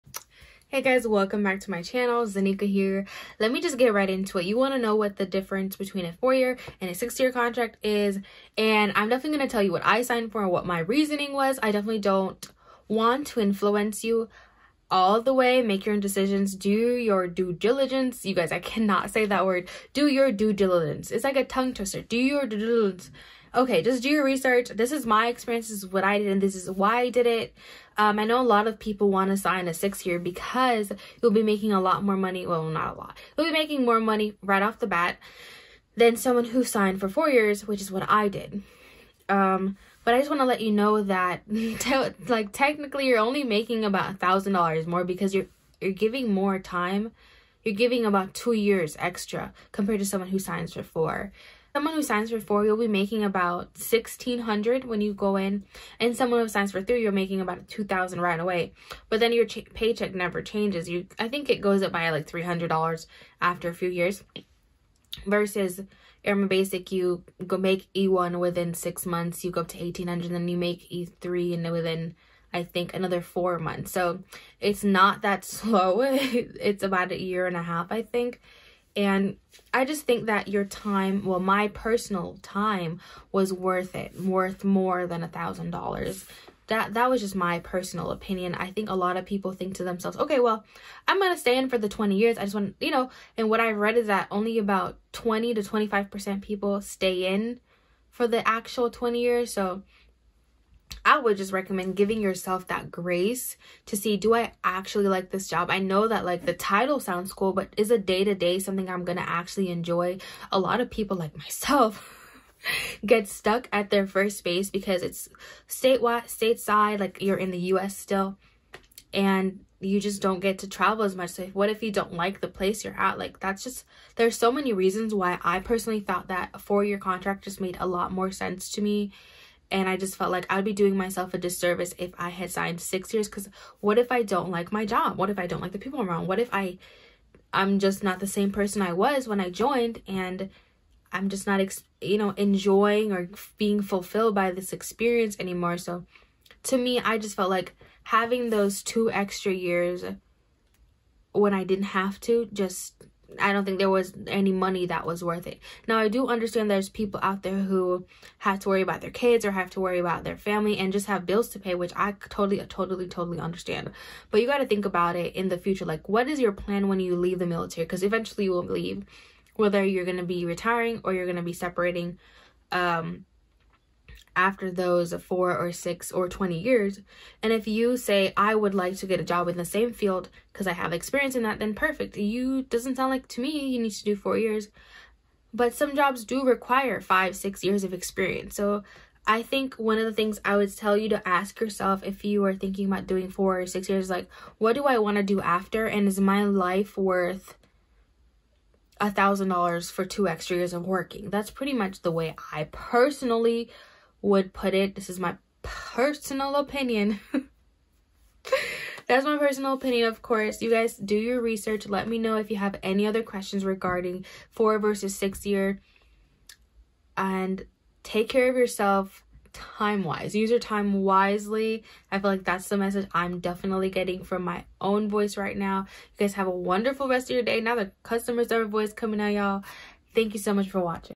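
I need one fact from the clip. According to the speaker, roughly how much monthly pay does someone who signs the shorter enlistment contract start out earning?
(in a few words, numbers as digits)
1600.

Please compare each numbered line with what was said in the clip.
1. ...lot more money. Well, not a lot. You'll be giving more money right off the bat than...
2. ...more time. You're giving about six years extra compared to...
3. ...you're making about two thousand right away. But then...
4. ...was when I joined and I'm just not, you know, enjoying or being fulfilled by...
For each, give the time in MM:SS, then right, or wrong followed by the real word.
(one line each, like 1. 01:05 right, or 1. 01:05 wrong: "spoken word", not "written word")
1. 00:31 wrong: "making", not "giving"
2. 00:46 wrong: "two", not "six"
3. 00:57 right
4. 02:18 right.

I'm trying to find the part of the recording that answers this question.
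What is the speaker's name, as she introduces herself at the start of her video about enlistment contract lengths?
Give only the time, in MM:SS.
00:02.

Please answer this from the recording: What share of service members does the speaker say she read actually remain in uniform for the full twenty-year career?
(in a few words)
20 to 25 percent.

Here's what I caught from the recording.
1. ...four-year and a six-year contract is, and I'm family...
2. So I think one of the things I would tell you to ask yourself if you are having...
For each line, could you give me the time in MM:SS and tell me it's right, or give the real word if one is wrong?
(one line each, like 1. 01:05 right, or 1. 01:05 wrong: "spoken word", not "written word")
1. 00:06 wrong: "definitely", not "family"
2. 03:08 wrong: "thinking", not "having".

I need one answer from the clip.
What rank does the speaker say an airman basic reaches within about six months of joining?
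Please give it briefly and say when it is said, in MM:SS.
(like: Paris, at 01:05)
E1, at 01:07.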